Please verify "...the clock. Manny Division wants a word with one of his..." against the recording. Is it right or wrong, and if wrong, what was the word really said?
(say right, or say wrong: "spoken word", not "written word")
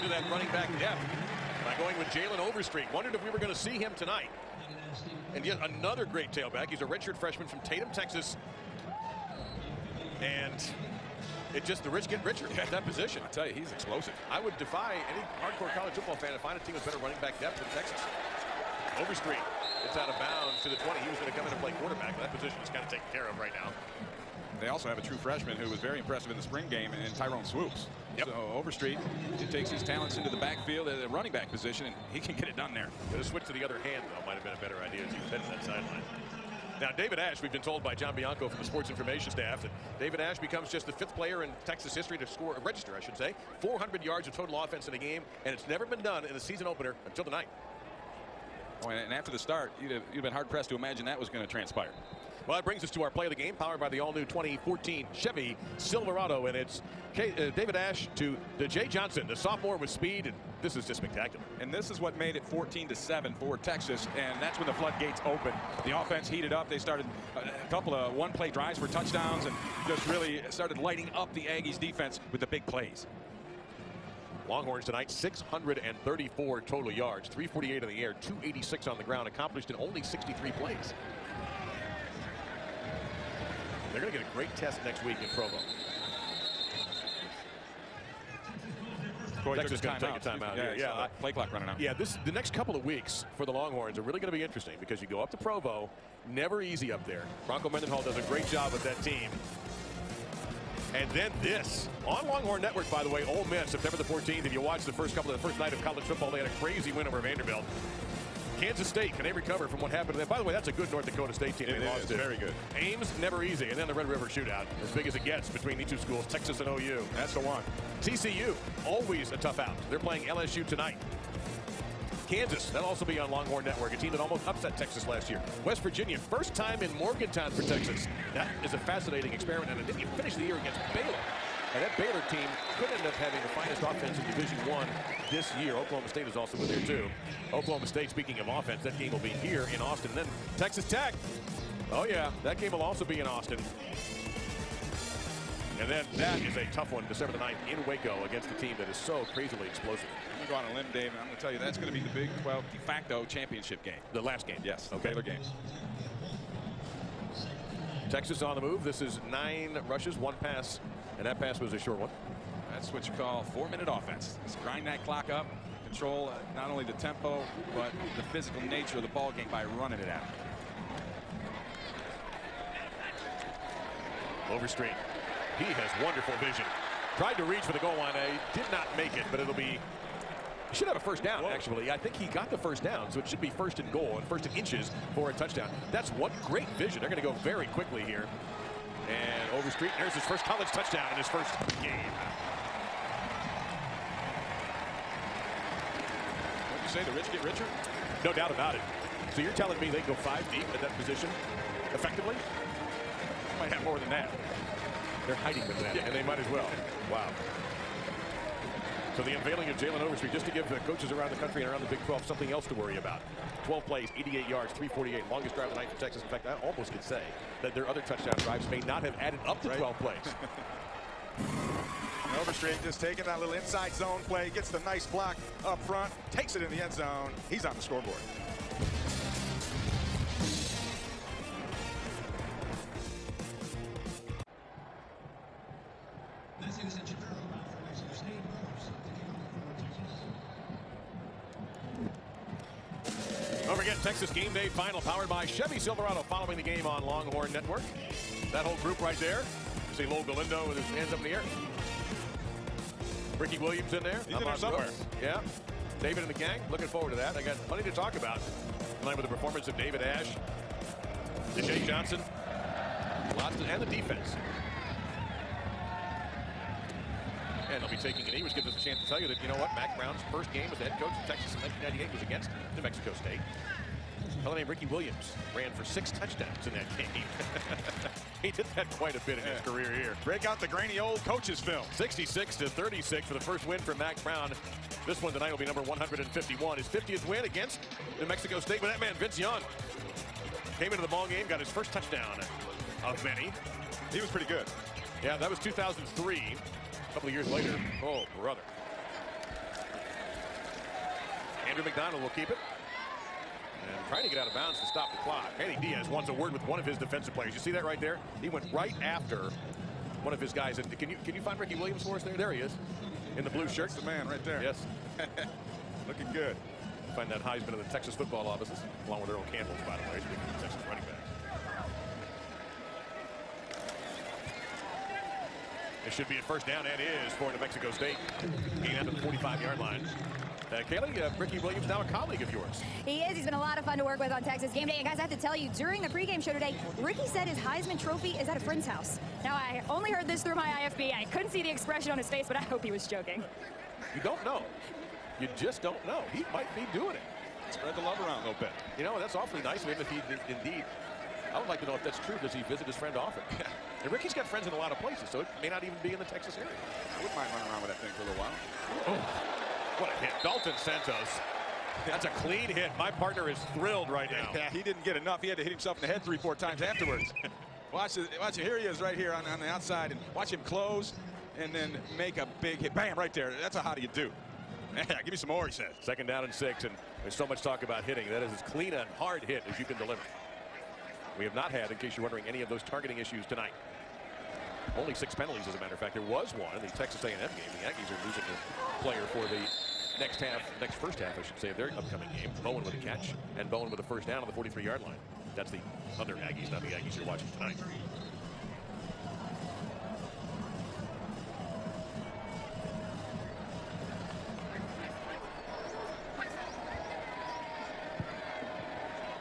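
wrong: "Diaz", not "Division".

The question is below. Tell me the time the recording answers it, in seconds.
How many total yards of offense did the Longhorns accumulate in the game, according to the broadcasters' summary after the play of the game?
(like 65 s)
75 s.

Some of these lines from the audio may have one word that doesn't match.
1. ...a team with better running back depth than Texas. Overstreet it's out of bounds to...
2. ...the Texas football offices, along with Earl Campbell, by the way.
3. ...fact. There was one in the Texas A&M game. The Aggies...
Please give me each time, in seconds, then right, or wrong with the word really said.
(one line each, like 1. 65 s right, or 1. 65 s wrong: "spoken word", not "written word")
1. 16 s right
2. 317 s right
3. 385 s right.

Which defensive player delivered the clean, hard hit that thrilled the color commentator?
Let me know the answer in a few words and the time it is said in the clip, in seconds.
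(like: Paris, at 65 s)
Dalton Santos, at 360 s.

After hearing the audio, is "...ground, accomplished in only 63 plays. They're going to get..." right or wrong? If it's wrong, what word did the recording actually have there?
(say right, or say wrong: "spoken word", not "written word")
right.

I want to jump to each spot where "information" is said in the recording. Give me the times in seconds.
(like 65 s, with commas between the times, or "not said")
38 s.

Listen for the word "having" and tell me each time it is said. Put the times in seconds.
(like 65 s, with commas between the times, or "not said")
133 s.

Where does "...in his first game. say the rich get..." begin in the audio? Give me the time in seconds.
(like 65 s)
191 s.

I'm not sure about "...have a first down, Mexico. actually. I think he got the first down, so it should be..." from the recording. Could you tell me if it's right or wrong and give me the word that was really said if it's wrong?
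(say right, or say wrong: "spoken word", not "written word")
wrong: "Whoa", not "Mexico".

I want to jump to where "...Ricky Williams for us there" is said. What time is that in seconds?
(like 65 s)
311 s.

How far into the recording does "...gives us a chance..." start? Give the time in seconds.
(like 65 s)
268 s.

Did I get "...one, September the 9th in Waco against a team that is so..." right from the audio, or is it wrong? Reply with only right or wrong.
wrong.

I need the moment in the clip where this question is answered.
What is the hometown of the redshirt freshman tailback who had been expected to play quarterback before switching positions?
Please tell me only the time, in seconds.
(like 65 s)
7 s.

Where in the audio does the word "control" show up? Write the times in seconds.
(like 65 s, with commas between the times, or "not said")
165 s.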